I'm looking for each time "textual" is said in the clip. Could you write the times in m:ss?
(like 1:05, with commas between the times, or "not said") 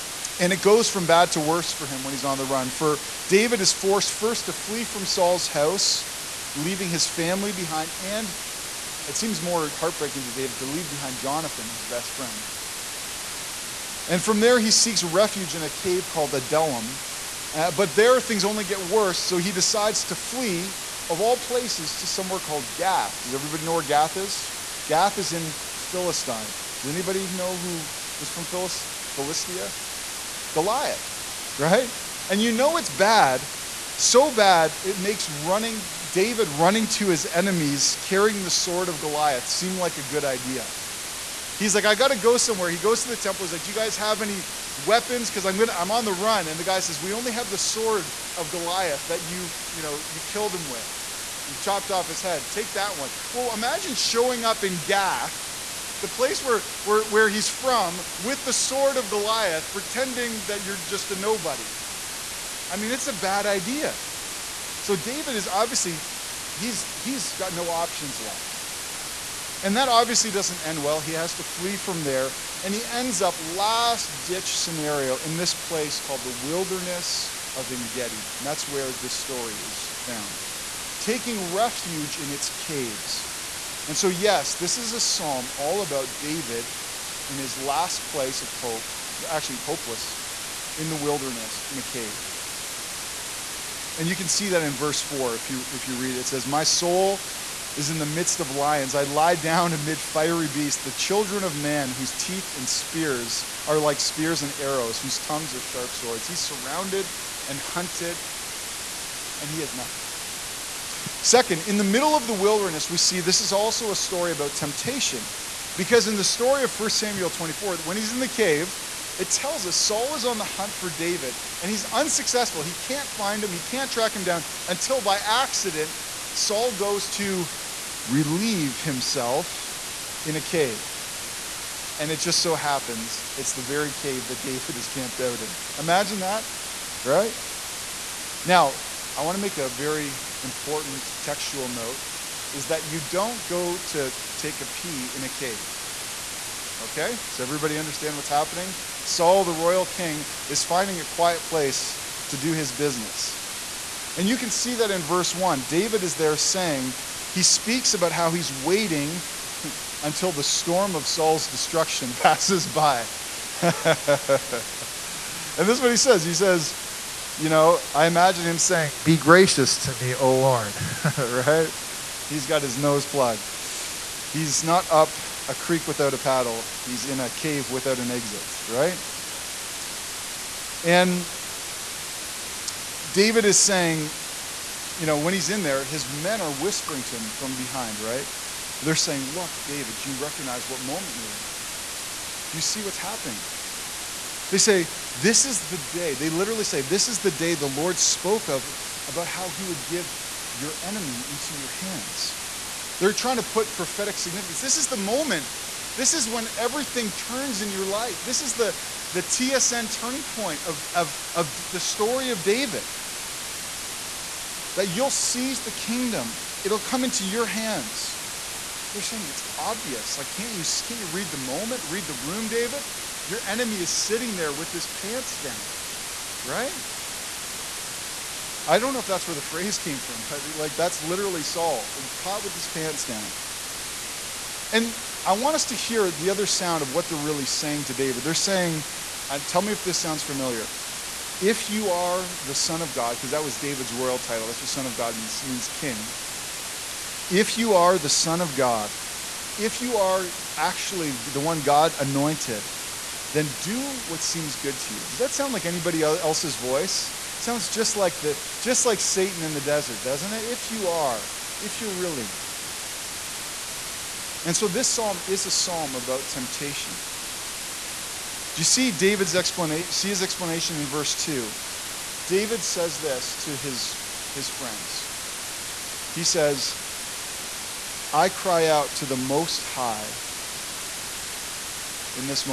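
2:21.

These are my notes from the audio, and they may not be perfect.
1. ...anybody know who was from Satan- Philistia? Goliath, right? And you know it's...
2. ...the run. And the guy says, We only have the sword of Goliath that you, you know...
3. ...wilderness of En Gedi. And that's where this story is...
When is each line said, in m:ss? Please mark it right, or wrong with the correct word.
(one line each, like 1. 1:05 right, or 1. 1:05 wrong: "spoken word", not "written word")
1. 0:26 wrong: "Philis", not "Satan"
2. 0:46 right
3. 1:16 right.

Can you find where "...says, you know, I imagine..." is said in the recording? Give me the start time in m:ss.
2:46.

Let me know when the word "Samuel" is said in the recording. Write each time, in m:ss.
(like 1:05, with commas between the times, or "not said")
1:56.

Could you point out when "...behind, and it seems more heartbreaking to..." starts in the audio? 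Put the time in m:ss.
0:07.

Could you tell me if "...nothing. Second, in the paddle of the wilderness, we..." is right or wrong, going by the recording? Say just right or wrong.
wrong.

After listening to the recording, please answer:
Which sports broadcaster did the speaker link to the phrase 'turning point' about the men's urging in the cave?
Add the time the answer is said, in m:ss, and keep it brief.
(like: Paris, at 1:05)
TSN, at 3:29.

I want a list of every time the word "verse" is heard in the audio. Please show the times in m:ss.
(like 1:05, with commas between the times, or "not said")
1:34, 2:35, 4:30.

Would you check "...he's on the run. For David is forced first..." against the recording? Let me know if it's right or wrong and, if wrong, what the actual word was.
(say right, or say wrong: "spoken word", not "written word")
right.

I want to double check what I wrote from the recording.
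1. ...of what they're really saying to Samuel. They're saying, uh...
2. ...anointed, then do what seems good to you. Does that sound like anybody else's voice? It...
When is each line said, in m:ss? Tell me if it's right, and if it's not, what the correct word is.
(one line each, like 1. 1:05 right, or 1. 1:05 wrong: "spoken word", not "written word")
1. 3:56 wrong: "David", not "Samuel"
2. 4:11 right.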